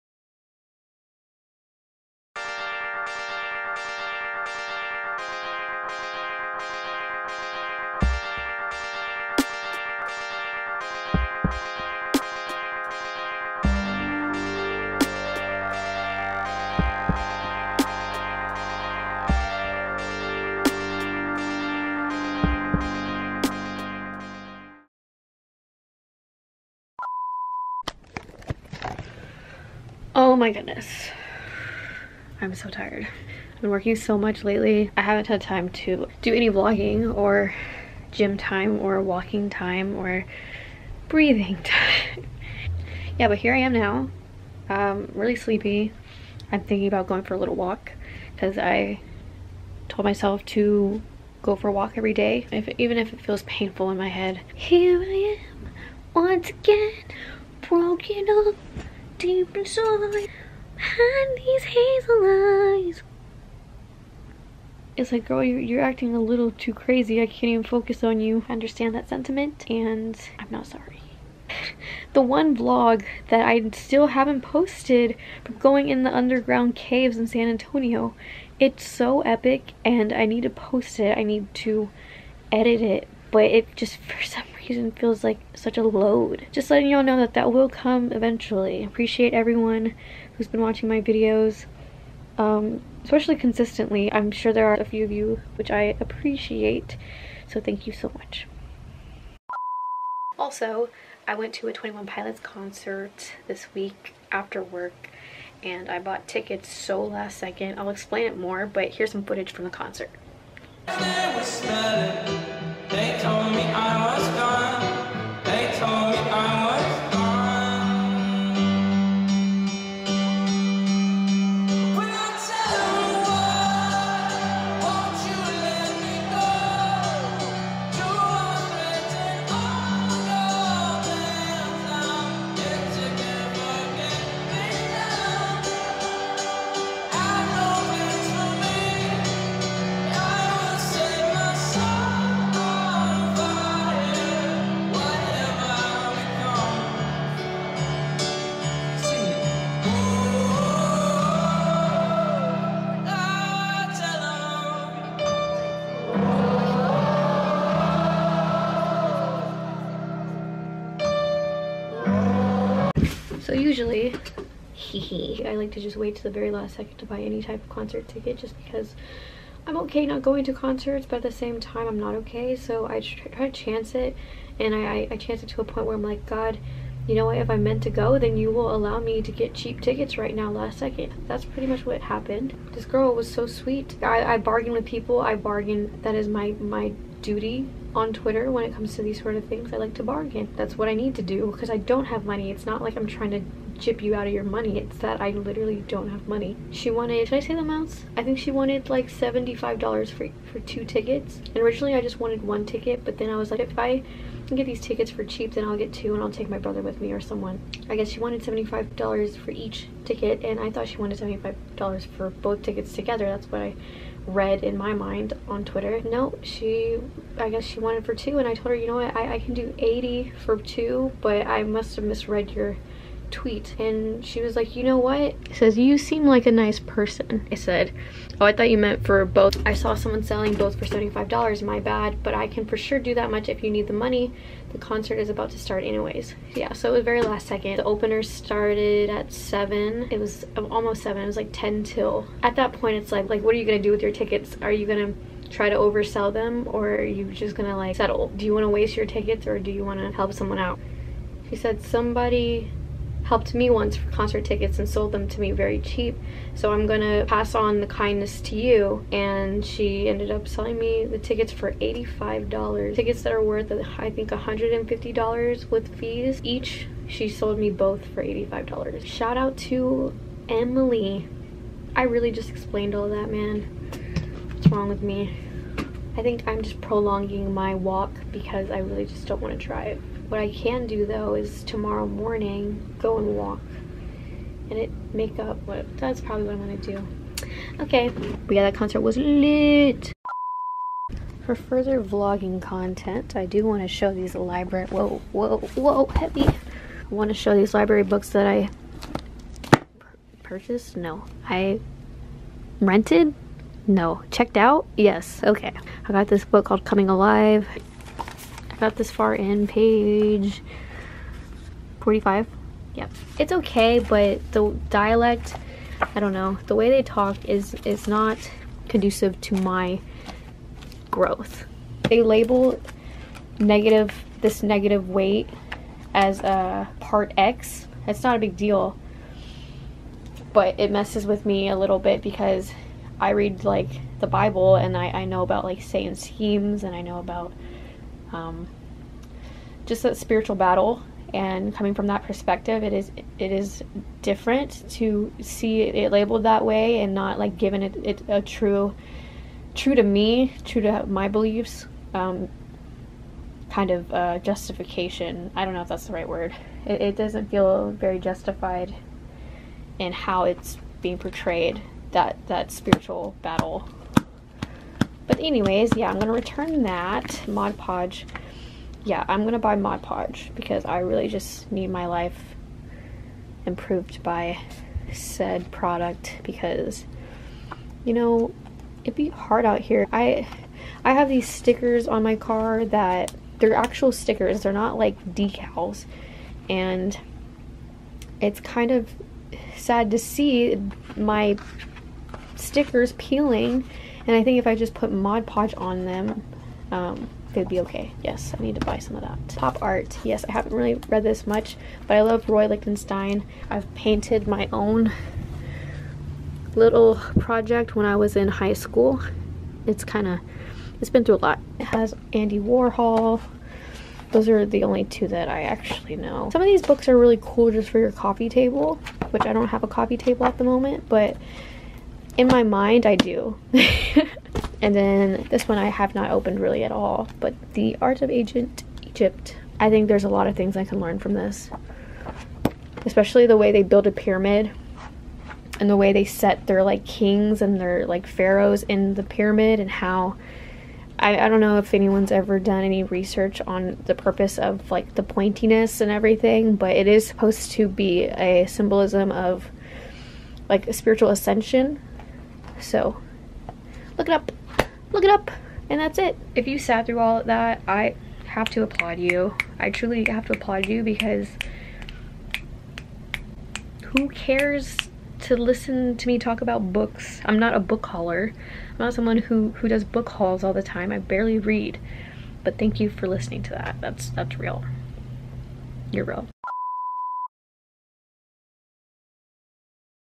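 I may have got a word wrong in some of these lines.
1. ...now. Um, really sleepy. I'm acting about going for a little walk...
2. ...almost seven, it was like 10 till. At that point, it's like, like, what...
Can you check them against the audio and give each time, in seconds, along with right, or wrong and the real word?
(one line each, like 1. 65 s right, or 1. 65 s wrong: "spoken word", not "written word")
1. 43 s wrong: "thinking", not "acting"
2. 240 s right.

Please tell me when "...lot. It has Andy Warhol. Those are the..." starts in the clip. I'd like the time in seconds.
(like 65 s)
411 s.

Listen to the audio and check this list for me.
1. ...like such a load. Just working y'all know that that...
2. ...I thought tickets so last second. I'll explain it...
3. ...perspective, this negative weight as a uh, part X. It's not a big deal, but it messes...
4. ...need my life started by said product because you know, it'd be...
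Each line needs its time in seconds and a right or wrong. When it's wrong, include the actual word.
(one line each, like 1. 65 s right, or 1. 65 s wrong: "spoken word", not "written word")
1. 85 s wrong: "letting", not "working"
2. 105 s wrong: "bought", not "thought"
3. 323 s wrong: "negative", not "perspective"
4. 371 s wrong: "improved", not "started".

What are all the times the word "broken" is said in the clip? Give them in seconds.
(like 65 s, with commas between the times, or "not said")
57 s.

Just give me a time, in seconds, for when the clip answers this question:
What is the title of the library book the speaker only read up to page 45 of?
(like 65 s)
306 s.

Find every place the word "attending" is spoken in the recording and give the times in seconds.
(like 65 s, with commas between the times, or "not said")
not said.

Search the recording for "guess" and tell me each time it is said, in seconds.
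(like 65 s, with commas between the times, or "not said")
207 s, 217 s.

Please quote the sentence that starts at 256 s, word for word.
So I'm gonna pass on the kindness to you.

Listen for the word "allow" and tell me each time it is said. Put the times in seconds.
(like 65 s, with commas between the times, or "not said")
178 s.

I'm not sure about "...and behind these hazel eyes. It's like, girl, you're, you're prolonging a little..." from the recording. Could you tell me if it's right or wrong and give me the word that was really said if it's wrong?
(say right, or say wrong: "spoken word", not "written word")
wrong: "acting", not "prolonging".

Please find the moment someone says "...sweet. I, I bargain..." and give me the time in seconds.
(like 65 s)
183 s.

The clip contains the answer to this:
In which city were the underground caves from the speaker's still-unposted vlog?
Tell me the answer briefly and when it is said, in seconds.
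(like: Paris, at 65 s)
San Antonio, at 77 s.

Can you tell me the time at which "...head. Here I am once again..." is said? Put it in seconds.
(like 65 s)
54 s.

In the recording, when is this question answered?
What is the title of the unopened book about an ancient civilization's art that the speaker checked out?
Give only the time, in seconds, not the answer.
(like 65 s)
427 s.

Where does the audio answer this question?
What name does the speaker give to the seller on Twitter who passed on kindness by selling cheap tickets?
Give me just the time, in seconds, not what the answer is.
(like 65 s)
270 s.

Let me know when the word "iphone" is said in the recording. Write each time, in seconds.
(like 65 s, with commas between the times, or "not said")
not said.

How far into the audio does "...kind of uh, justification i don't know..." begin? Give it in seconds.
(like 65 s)
353 s.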